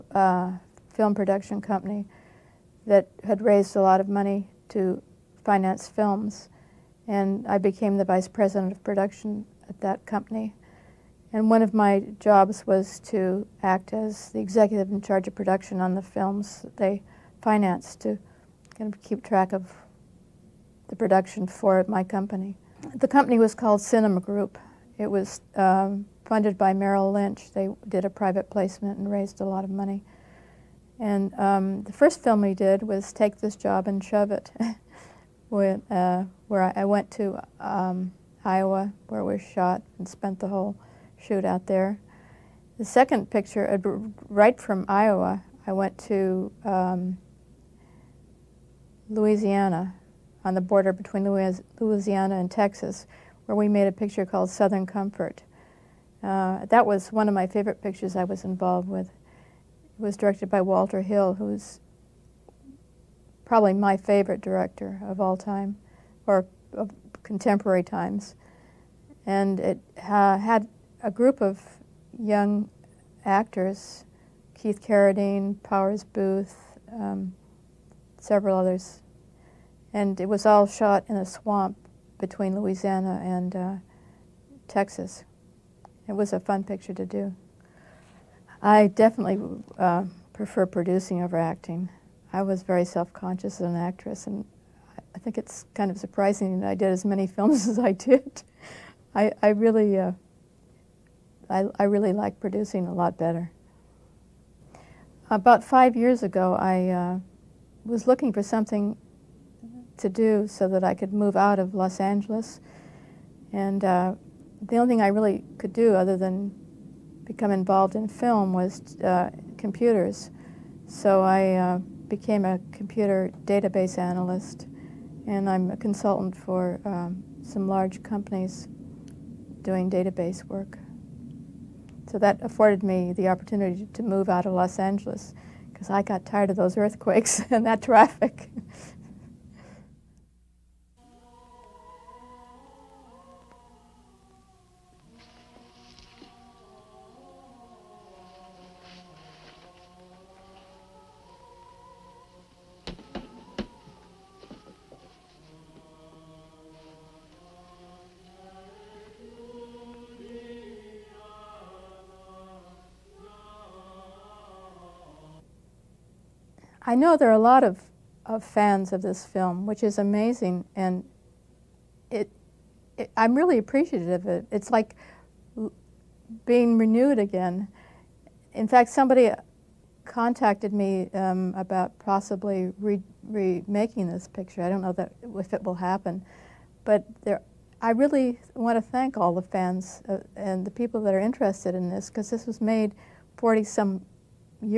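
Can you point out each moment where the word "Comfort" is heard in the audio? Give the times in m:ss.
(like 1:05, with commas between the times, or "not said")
0:54.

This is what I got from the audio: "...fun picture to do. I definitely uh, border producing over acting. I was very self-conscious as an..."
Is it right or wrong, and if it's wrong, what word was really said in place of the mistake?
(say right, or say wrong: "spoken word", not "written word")
wrong: "prefer", not "border".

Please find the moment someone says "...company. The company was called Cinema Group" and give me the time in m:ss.
0:22.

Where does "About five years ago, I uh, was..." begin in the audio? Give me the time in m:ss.
1:45.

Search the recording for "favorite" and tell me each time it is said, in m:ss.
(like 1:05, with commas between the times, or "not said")
0:57, 1:03.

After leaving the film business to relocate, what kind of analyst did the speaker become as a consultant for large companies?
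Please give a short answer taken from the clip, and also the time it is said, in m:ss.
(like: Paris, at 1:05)
Computer database analyst, at 2:02.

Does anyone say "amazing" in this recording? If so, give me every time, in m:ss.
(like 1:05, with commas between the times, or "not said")
2:49.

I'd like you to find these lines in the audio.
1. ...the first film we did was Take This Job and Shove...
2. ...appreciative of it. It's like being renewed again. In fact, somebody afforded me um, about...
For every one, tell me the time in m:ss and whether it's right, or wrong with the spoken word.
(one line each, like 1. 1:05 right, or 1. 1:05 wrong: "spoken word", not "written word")
1. 0:31 right
2. 2:53 wrong: "contacted", not "afforded".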